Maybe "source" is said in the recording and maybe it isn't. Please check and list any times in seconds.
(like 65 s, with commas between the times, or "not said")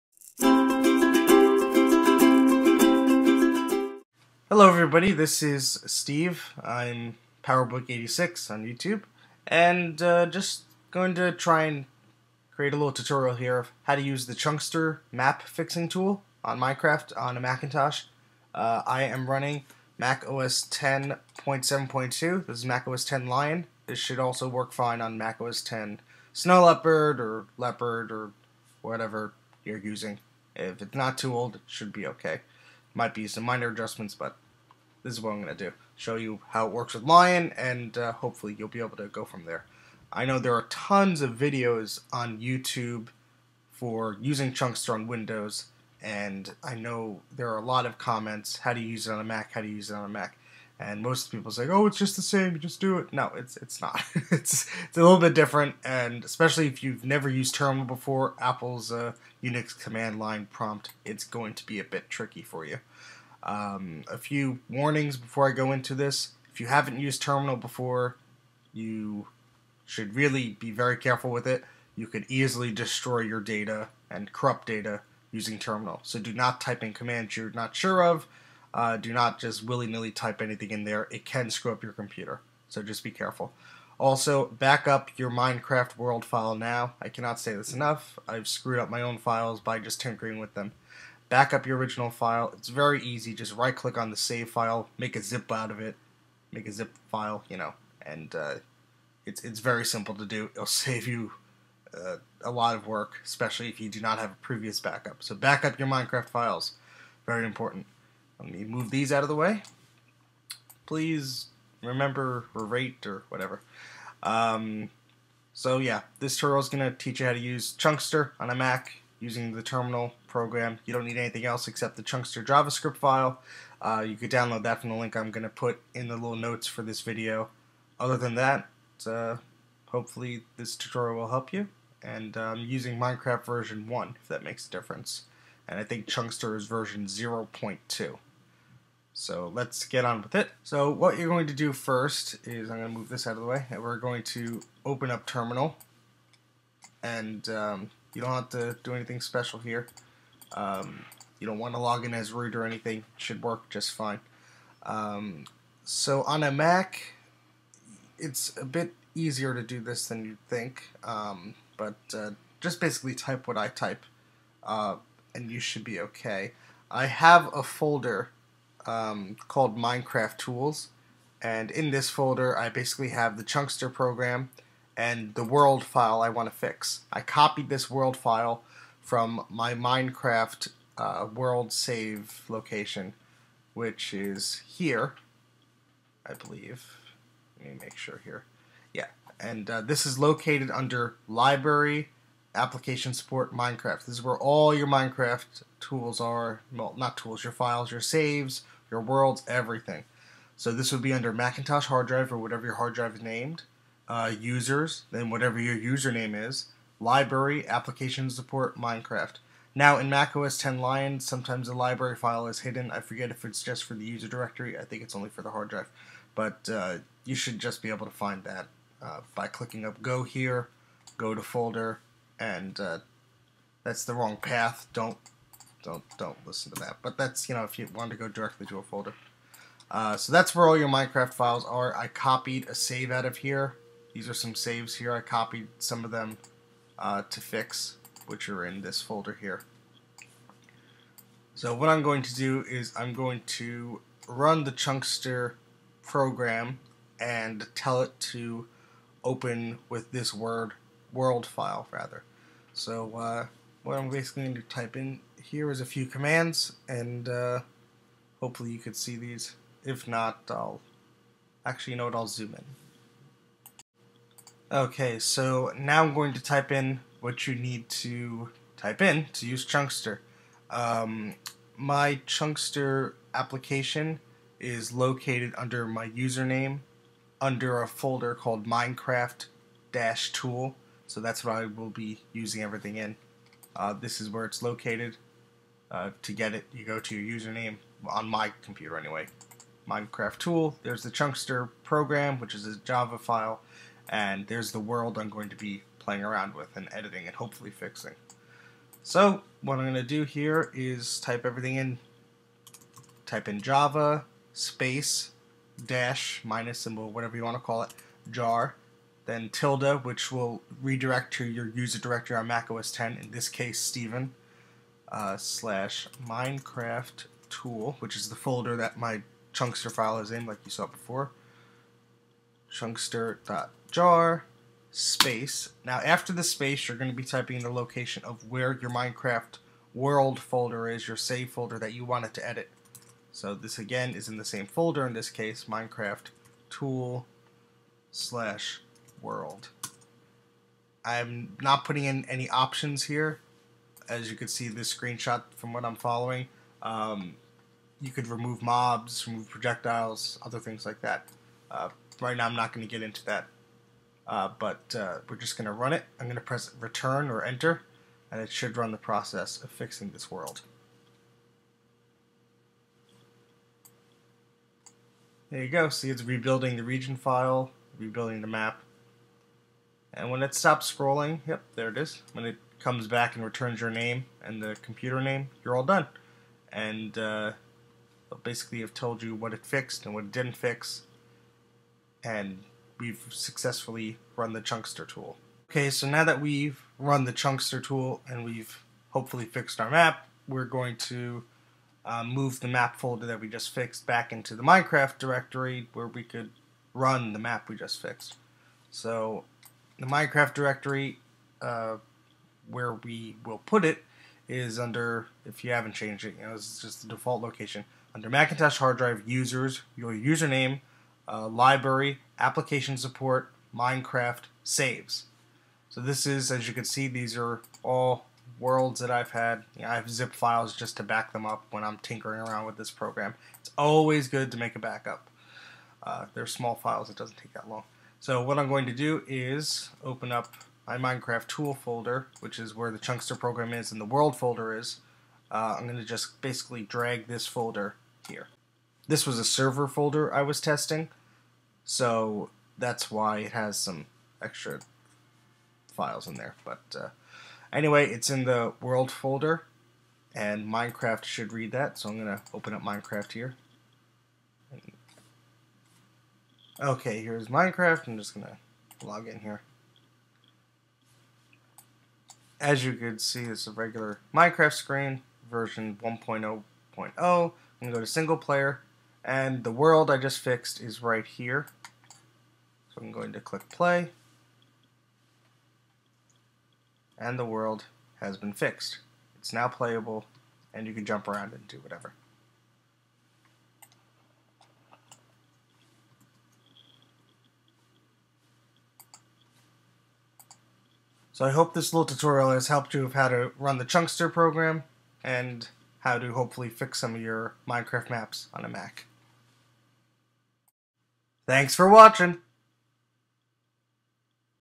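not said.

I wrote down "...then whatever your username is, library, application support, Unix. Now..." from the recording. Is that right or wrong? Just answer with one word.
wrong.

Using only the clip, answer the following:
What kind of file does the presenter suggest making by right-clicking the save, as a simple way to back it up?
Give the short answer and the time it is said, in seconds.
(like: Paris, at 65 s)
zip file, at 96 s.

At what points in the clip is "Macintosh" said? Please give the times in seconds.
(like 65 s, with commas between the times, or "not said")
17 s, 201 s, 408 s.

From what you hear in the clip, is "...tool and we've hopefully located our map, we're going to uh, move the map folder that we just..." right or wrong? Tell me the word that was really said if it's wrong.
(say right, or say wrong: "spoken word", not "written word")
wrong: "fixed", not "located".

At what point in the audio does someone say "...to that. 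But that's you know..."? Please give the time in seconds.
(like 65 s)
226 s.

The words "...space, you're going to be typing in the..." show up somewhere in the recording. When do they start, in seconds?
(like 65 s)
326 s.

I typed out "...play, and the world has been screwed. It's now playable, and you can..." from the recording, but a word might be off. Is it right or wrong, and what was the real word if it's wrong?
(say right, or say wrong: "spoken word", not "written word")
wrong: "fixed", not "screwed".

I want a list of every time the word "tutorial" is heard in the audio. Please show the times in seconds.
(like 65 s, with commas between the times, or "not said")
12 s, 116 s, 130 s, 492 s.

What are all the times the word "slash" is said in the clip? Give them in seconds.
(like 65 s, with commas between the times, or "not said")
315 s, 338 s.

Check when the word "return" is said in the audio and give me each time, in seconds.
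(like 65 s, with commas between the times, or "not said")
356 s, 373 s.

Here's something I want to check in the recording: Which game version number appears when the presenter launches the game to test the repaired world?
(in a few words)
1.0.0.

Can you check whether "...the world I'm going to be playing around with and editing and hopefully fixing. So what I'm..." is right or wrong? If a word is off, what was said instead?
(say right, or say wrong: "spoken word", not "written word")
right.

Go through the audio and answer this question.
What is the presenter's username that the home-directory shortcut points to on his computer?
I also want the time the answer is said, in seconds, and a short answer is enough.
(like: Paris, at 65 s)
Steven, at 313 s.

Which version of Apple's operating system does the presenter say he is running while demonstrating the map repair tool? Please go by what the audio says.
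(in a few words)
Mac OS 10.7.2.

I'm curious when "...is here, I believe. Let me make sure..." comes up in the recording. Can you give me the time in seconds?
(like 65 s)
184 s.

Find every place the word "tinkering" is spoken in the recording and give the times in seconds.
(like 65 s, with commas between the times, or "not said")
90 s, 421 s.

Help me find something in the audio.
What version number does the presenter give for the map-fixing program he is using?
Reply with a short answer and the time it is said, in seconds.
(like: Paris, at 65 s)
0.2, at 136 s.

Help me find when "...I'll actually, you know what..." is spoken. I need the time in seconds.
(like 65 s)
260 s.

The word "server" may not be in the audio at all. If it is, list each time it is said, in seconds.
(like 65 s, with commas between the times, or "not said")
439 s.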